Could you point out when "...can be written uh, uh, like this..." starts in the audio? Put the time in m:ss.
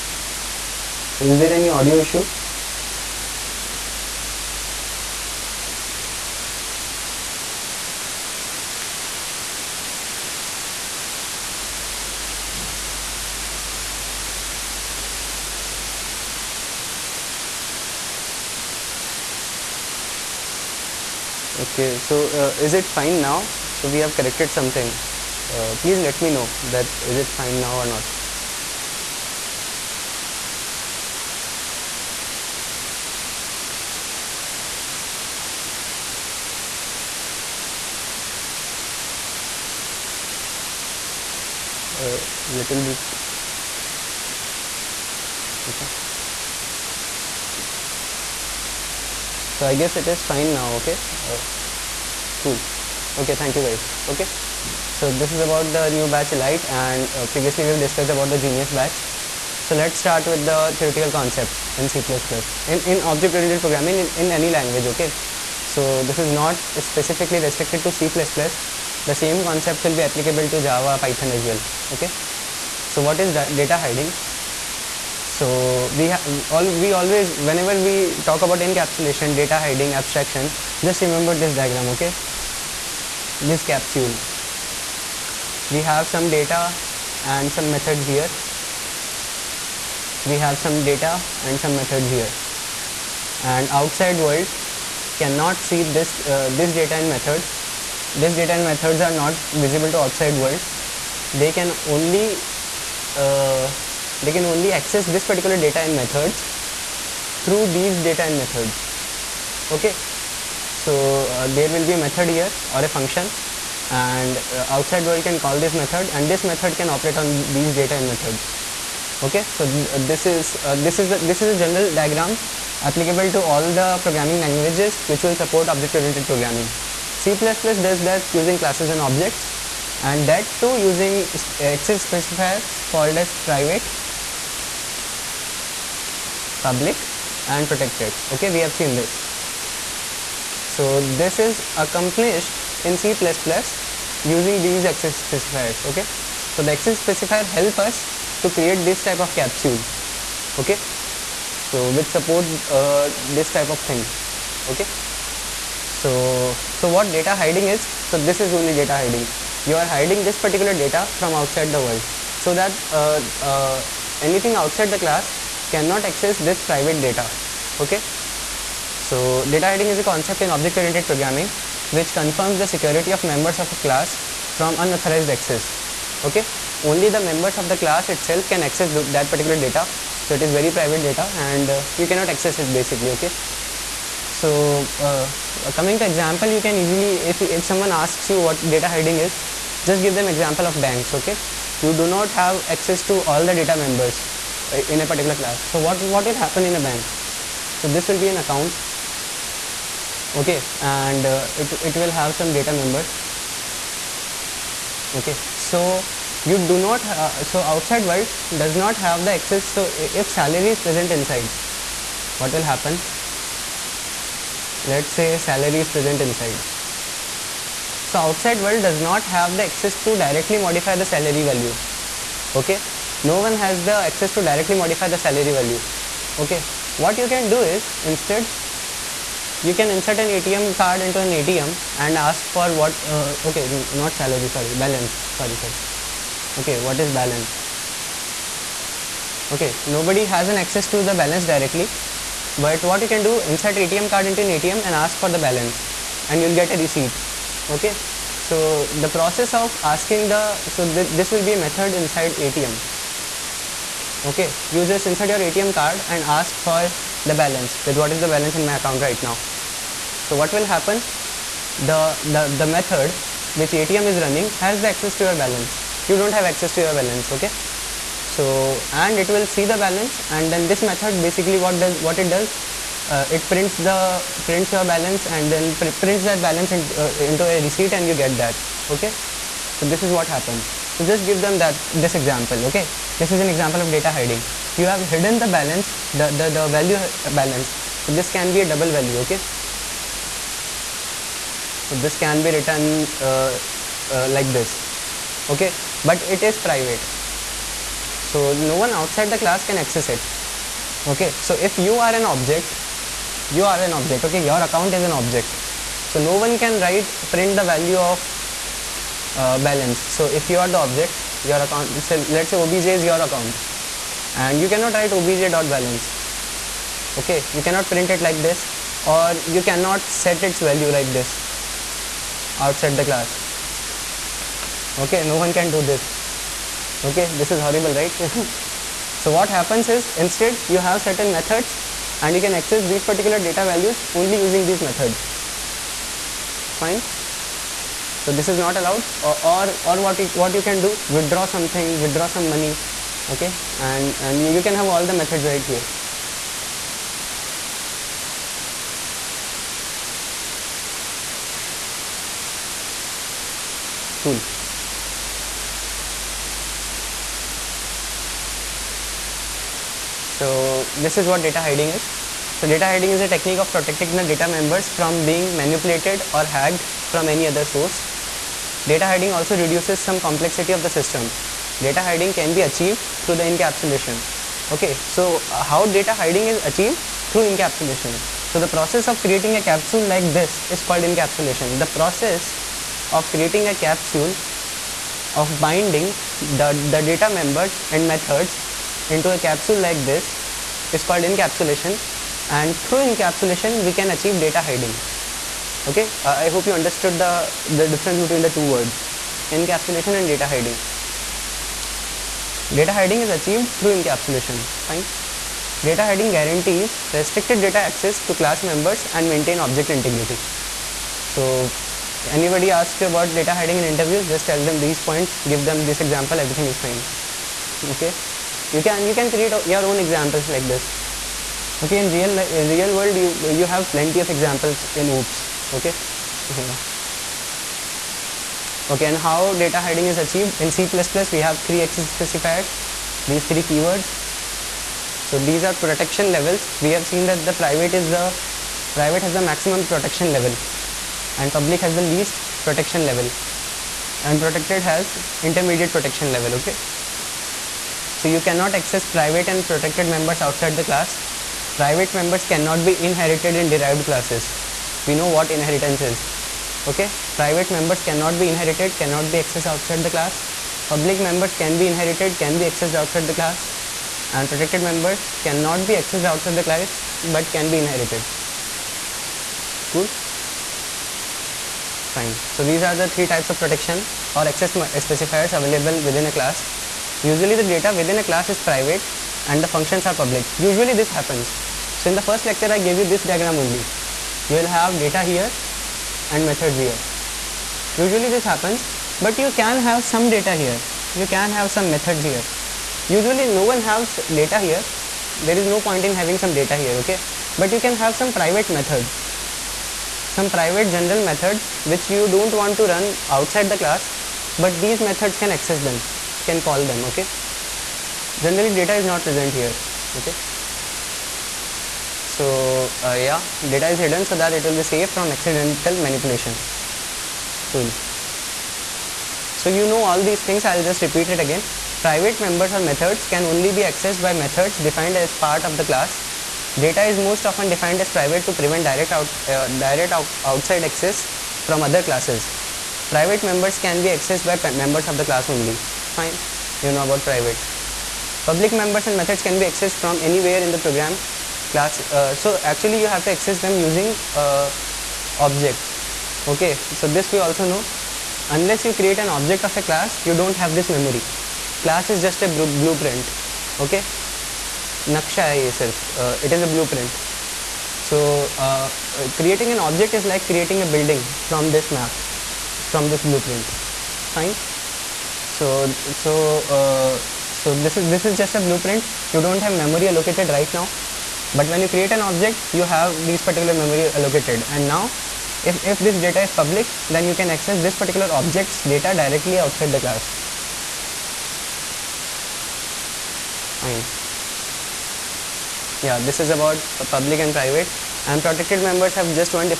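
4:52.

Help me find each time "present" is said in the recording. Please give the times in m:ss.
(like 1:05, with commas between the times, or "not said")
3:30, 3:35, 8:29.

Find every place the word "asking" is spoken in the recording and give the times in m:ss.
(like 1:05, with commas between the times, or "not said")
4:09.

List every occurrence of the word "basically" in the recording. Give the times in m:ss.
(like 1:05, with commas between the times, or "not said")
3:02, 4:31.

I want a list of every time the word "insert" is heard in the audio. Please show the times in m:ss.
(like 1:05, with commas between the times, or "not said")
3:49, 4:03, 4:15.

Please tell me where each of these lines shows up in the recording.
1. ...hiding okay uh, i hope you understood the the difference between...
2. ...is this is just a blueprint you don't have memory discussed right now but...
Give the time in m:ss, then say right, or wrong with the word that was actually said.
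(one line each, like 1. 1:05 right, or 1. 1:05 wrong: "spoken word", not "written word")
1. 6:34 right
2. 9:28 wrong: "allocated", not "discussed".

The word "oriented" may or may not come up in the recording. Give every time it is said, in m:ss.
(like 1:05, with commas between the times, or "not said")
1:03, 2:06, 2:50.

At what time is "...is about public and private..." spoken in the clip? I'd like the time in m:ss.
9:46.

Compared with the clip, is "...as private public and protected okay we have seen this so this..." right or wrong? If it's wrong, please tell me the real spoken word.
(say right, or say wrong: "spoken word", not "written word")
right.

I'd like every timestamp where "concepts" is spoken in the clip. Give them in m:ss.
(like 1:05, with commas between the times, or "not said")
1:01, 1:09, 2:50.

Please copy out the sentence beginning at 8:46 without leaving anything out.
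Data is most often defined as private to prevent direct, out, uh, direct out, outside access from other classes.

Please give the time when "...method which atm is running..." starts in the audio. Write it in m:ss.
4:22.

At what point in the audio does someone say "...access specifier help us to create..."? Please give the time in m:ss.
2:26.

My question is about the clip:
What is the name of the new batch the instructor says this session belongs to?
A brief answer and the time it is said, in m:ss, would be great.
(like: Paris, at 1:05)
Elite, at 0:56.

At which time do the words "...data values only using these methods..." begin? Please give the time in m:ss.
5:33.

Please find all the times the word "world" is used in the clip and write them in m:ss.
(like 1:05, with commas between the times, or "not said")
1:34, 1:40, 1:55, 2:41, 3:28, 3:38, 7:02.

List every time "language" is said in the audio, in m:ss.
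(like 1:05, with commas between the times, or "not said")
1:04, 2:04.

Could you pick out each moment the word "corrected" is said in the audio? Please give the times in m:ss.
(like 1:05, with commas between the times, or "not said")
0:24.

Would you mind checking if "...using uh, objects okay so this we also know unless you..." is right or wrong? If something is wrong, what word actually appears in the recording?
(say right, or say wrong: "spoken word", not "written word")
right.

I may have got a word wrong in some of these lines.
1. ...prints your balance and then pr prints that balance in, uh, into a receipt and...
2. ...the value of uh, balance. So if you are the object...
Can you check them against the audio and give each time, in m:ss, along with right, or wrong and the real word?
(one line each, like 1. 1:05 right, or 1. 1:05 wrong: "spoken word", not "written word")
1. 4:34 right
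2. 5:07 right.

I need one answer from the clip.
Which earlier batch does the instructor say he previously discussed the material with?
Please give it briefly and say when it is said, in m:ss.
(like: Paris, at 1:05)
genius, at 0:58.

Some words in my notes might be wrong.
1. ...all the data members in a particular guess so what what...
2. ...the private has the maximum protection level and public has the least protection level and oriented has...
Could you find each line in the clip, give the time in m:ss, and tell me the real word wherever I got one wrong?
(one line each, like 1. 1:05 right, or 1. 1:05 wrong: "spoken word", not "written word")
1. 3:13 wrong: "class", not "guess"
2. 7:18 wrong: "protected", not "oriented".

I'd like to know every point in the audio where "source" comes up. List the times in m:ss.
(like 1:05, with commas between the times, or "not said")
6:07.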